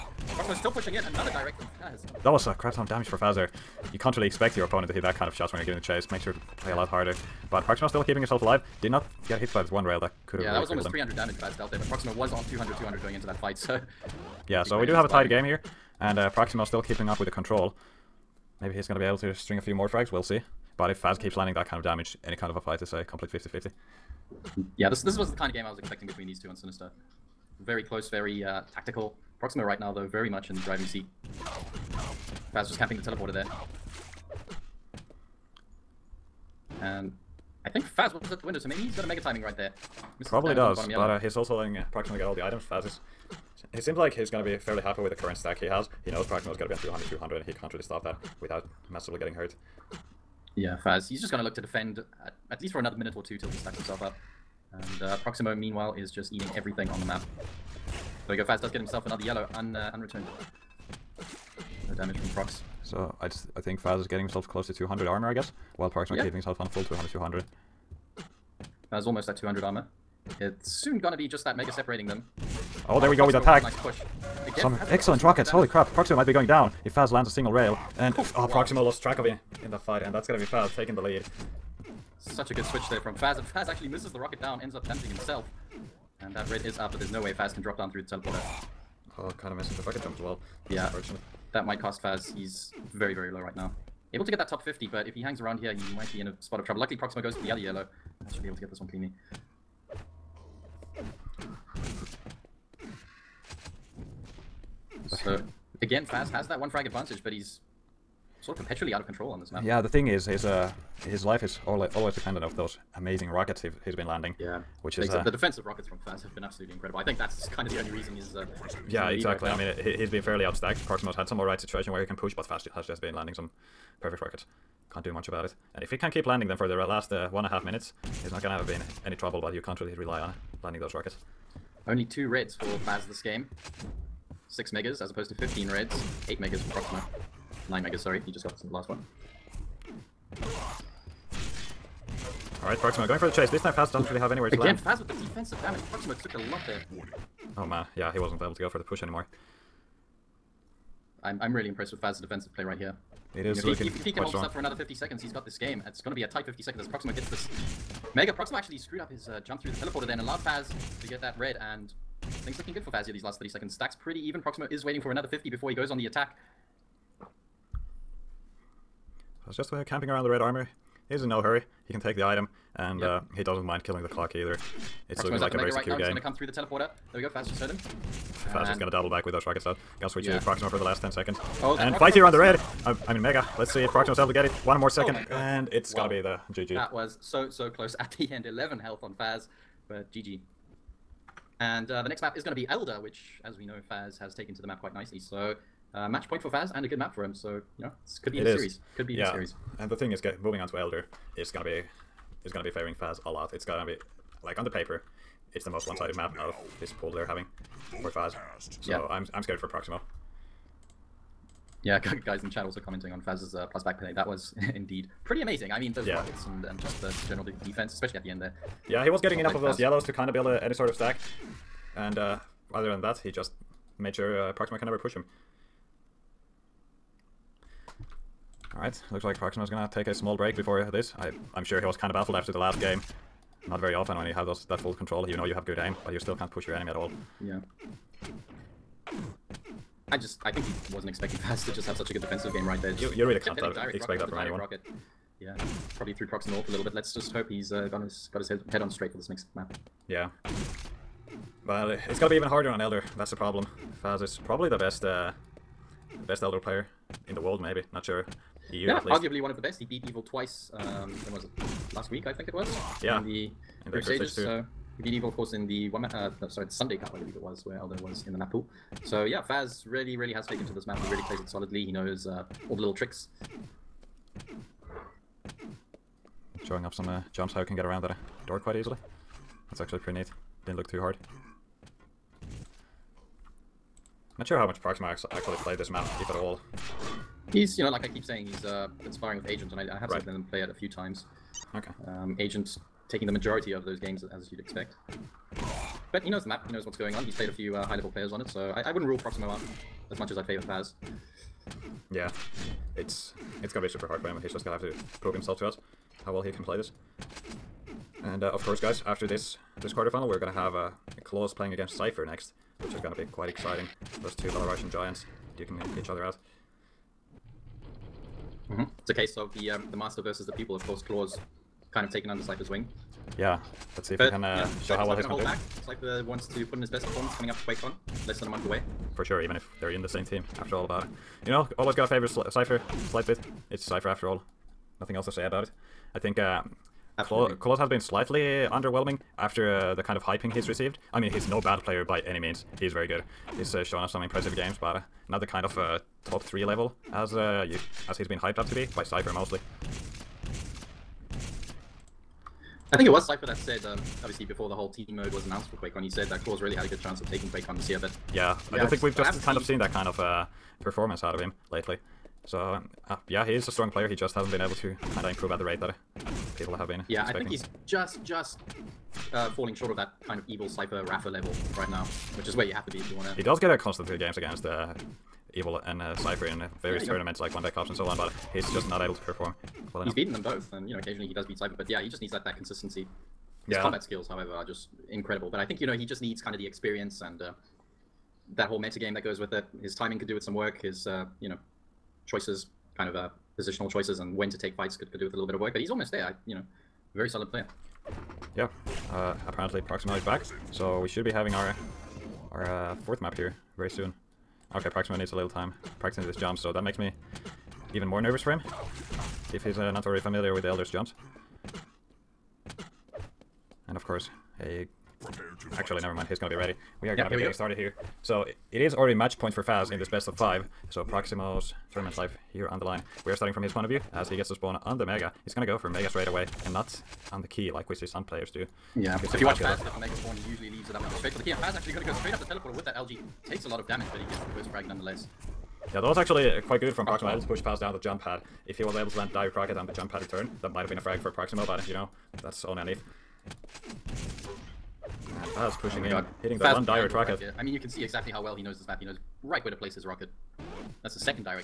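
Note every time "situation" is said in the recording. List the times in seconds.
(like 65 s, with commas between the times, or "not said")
121 s.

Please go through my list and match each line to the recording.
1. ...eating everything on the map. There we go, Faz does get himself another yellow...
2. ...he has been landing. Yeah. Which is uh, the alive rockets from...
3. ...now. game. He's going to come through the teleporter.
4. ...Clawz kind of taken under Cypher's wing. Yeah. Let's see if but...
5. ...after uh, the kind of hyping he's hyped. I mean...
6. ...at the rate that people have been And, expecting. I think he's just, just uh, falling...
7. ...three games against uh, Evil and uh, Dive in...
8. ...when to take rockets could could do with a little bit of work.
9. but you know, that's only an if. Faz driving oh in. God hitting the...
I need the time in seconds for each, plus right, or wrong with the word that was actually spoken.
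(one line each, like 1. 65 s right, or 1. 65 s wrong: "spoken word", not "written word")
1. 56 s right
2. 113 s wrong: "defensive", not "alive"
3. 175 s right
4. 321 s right
5. 339 s wrong: "received", not "hyped"
6. 365 s wrong: "Yeah", not "And"
7. 374 s wrong: "Cypher", not "Dive"
8. 394 s wrong: "fights", not "rockets"
9. 441 s wrong: "pushing", not "driving".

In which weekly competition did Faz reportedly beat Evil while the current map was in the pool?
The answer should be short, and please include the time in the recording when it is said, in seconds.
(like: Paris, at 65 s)
Sunday Cup, at 266 s.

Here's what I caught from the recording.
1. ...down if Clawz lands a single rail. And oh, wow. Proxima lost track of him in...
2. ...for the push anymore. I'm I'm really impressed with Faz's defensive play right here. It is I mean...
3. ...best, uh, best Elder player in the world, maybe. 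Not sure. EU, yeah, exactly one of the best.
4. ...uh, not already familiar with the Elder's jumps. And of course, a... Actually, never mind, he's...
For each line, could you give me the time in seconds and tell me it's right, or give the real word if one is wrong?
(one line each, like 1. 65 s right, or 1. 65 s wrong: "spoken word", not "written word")
1. 76 s wrong: "Faz", not "Clawz"
2. 148 s right
3. 254 s wrong: "arguably", not "exactly"
4. 409 s right.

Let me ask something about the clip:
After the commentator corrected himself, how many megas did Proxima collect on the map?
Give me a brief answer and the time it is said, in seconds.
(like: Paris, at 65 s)
9, at 137 s.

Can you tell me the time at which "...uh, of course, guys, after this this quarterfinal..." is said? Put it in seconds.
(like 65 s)
308 s.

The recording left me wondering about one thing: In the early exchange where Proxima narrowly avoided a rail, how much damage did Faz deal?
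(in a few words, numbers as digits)
300.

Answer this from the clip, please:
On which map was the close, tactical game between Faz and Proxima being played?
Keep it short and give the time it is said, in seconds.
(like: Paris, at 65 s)
Sinister, at 26 s.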